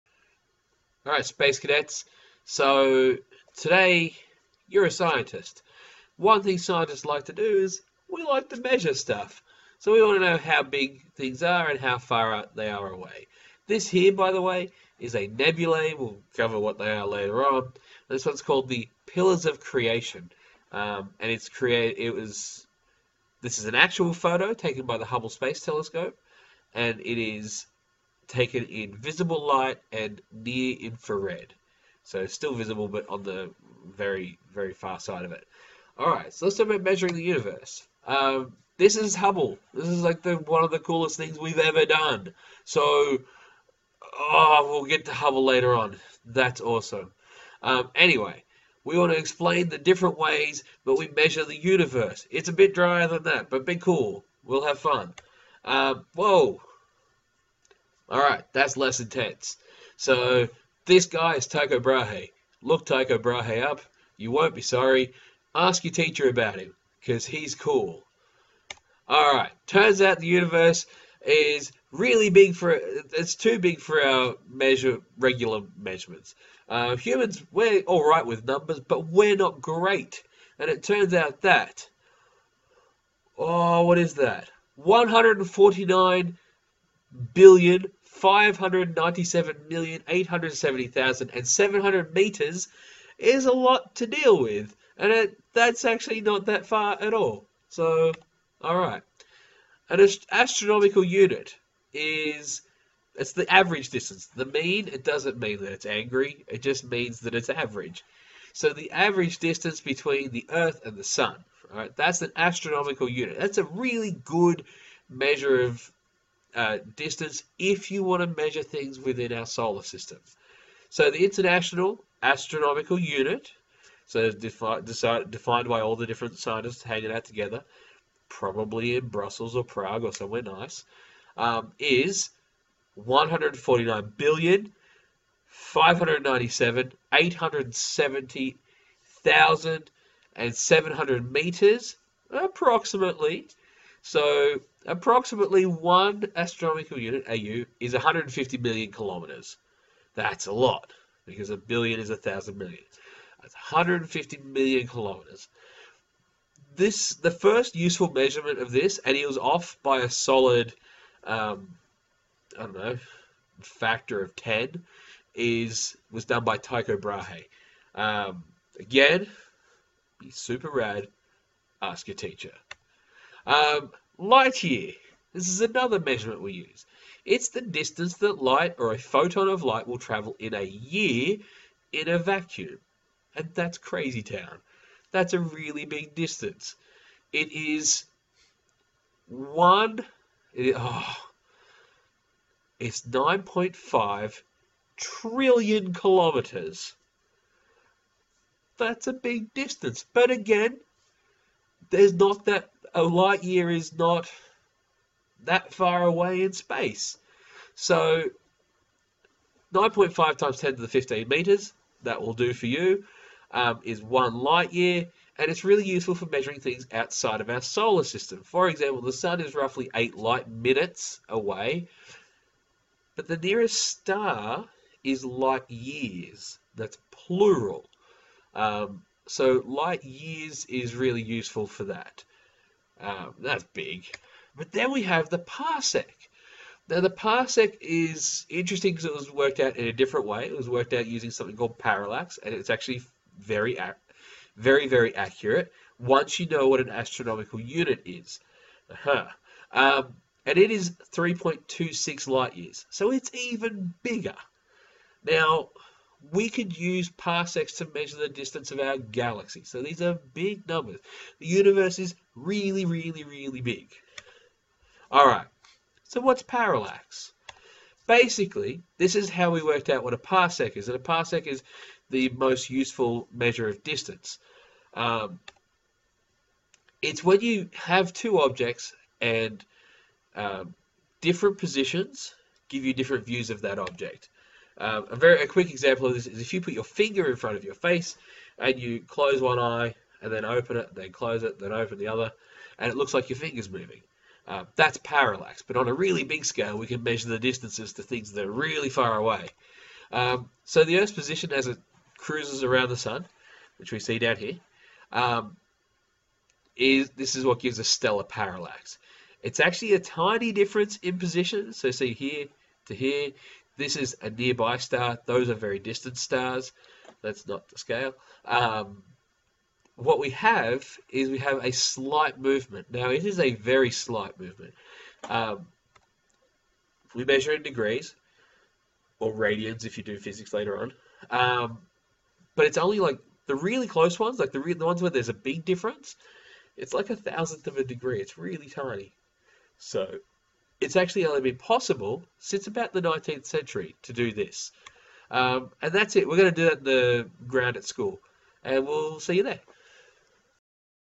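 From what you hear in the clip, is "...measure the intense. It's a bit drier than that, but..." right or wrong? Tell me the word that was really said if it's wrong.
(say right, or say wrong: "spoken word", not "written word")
wrong: "universe", not "intense".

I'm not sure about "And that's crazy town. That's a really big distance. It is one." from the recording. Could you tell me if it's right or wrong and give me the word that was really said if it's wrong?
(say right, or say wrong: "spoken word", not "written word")
right.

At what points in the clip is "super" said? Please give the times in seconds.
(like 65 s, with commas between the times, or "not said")
170 s.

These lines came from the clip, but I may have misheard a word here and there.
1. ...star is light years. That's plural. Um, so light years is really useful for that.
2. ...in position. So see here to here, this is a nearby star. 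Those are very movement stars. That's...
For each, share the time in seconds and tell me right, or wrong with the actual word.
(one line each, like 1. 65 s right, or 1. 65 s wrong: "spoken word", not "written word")
1. 223 s right
2. 310 s wrong: "distant", not "movement".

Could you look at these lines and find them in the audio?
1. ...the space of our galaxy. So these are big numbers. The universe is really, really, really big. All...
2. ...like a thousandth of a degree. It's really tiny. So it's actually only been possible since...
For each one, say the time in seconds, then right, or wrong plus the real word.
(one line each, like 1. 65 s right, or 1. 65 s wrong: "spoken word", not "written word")
1. 258 s wrong: "distance", not "space"
2. 336 s right.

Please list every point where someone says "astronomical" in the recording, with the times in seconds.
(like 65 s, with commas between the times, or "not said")
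100 s, 112 s, 122 s, 146 s, 246 s.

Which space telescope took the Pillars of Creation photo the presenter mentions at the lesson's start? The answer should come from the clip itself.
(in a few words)
Hubble Space Telescope.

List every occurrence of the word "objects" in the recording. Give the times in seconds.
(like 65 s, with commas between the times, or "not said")
278 s, 283 s.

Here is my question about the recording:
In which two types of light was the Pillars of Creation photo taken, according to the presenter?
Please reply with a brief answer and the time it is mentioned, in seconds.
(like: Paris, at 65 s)
Visible light and near infrared, at 28 s.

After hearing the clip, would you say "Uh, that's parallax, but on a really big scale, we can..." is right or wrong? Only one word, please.
right.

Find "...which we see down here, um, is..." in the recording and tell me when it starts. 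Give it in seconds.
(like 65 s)
303 s.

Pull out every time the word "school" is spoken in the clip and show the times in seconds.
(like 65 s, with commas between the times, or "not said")
347 s.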